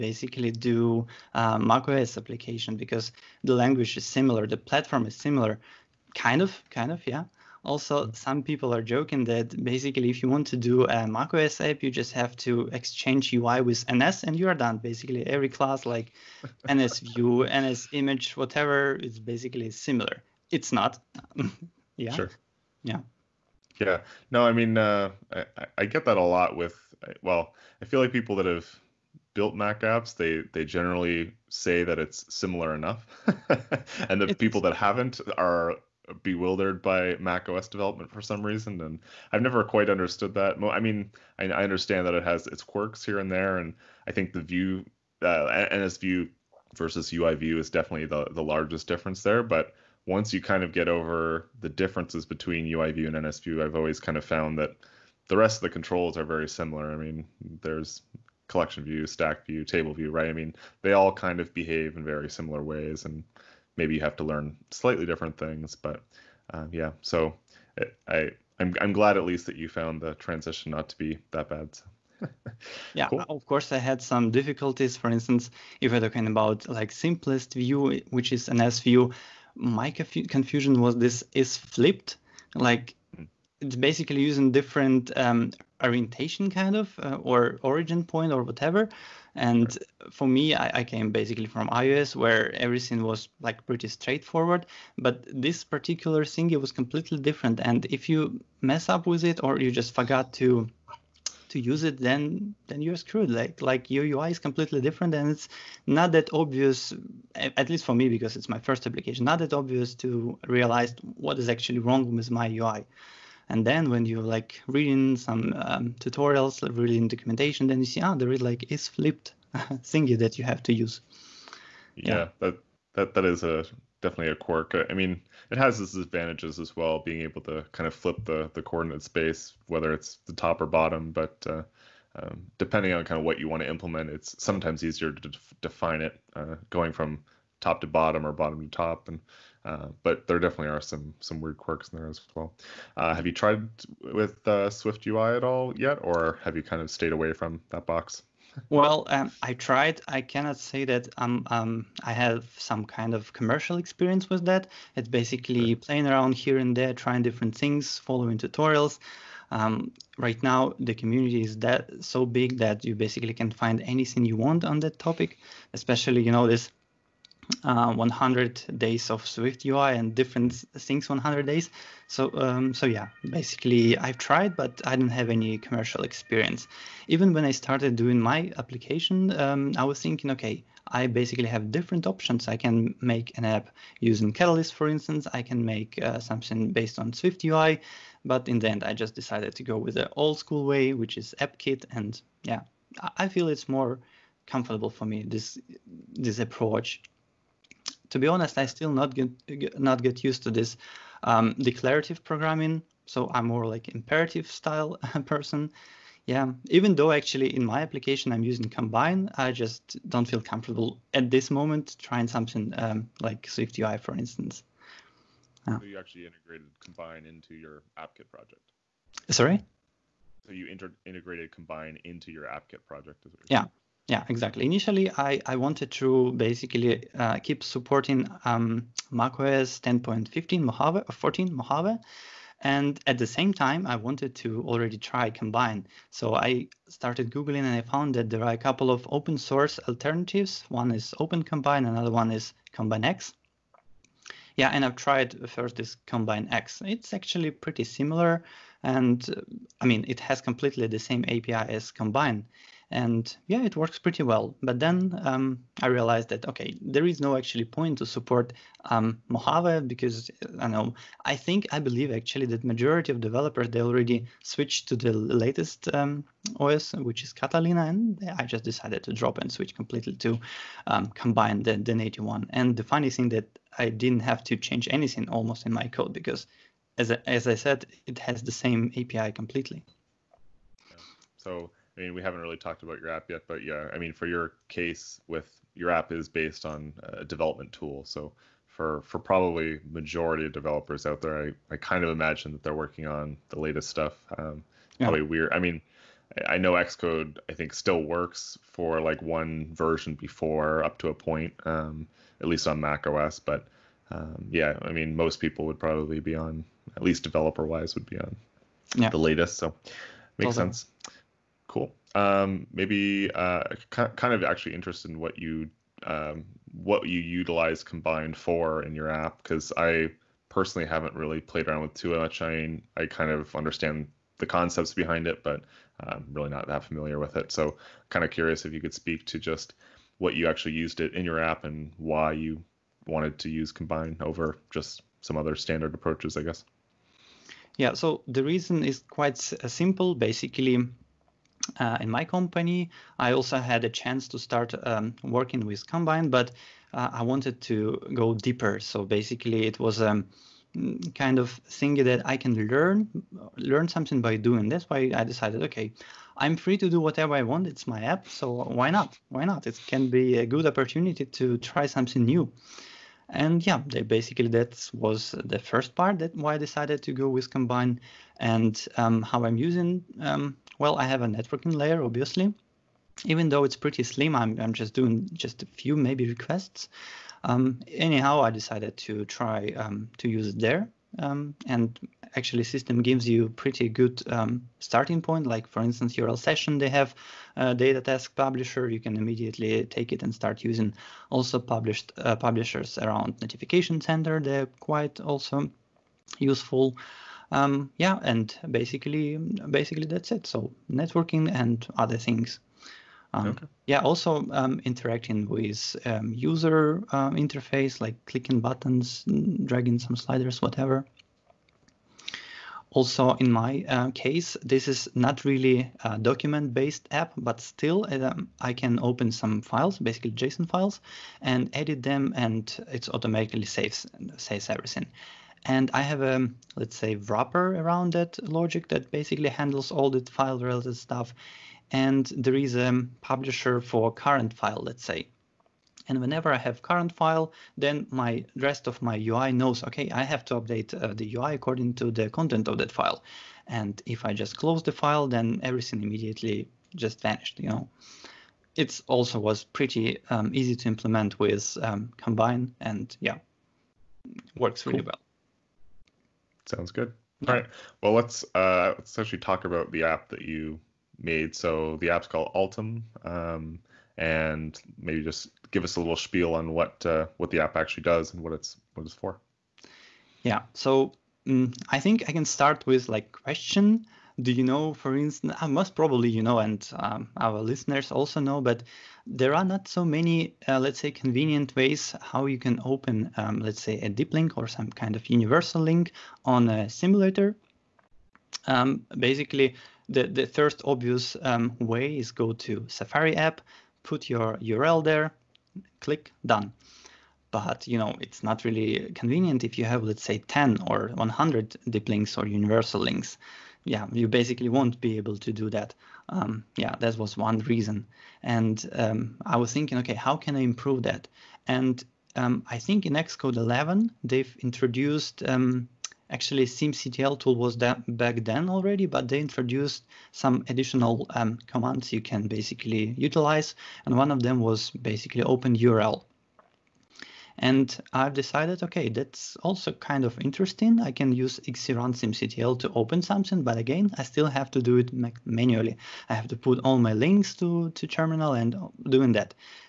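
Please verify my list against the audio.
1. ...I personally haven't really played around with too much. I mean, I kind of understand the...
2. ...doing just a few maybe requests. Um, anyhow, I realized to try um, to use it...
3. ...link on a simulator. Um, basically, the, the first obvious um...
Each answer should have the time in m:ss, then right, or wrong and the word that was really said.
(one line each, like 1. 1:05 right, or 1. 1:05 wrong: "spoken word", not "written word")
1. 5:19 right
2. 6:14 wrong: "decided", not "realized"
3. 8:05 right.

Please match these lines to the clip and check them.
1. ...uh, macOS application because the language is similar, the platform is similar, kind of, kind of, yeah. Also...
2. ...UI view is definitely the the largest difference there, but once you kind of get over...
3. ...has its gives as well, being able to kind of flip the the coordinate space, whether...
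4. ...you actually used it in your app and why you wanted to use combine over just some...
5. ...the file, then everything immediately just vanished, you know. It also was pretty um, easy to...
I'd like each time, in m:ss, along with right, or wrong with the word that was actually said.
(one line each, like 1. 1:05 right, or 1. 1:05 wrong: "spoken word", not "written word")
1. 0:01 right
2. 0:47 right
3. 2:05 wrong: "advantages", not "gives"
4. 5:30 right
5. 7:24 right.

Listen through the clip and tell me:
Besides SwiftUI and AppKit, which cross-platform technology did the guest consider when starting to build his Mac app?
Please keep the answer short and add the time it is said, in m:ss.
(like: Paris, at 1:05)
Catalyst, at 3:04.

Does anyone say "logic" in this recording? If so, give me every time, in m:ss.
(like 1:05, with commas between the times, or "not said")
7:08.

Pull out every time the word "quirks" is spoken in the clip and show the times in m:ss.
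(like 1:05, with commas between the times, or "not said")
0:42, 2:04, 2:21.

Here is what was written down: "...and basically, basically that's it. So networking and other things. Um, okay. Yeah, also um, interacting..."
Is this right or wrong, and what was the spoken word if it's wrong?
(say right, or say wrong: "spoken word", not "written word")
right.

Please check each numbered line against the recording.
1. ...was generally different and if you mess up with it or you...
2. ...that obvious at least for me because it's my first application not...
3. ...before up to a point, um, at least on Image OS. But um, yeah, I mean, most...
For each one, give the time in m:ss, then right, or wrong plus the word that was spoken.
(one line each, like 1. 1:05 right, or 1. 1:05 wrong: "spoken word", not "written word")
1. 1:36 wrong: "completely", not "generally"
2. 1:46 right
3. 5:00 wrong: "Mac", not "Image".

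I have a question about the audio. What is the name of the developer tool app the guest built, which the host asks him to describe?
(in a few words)
Altum.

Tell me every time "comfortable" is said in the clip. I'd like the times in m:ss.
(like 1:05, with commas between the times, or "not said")
3:14, 3:30.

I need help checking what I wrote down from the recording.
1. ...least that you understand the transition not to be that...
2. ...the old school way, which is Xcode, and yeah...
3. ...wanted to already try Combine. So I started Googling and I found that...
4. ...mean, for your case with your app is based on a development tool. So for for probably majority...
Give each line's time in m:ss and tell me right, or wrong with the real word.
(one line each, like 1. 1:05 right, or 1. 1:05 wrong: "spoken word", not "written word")
1. 1:09 wrong: "found", not "understand"
2. 3:09 wrong: "AppKit", not "Xcode"
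3. 3:53 right
4. 4:43 right.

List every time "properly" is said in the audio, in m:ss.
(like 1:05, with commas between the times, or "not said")
not said.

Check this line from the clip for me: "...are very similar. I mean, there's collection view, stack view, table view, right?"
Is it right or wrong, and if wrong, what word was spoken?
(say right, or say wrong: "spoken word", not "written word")
right.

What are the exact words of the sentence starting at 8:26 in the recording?
Um, yeah, that was one reason.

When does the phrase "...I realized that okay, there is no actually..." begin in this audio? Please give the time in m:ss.
4:15.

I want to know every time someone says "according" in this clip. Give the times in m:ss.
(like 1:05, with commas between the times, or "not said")
7:21.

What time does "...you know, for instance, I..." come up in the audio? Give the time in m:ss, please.
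7:54.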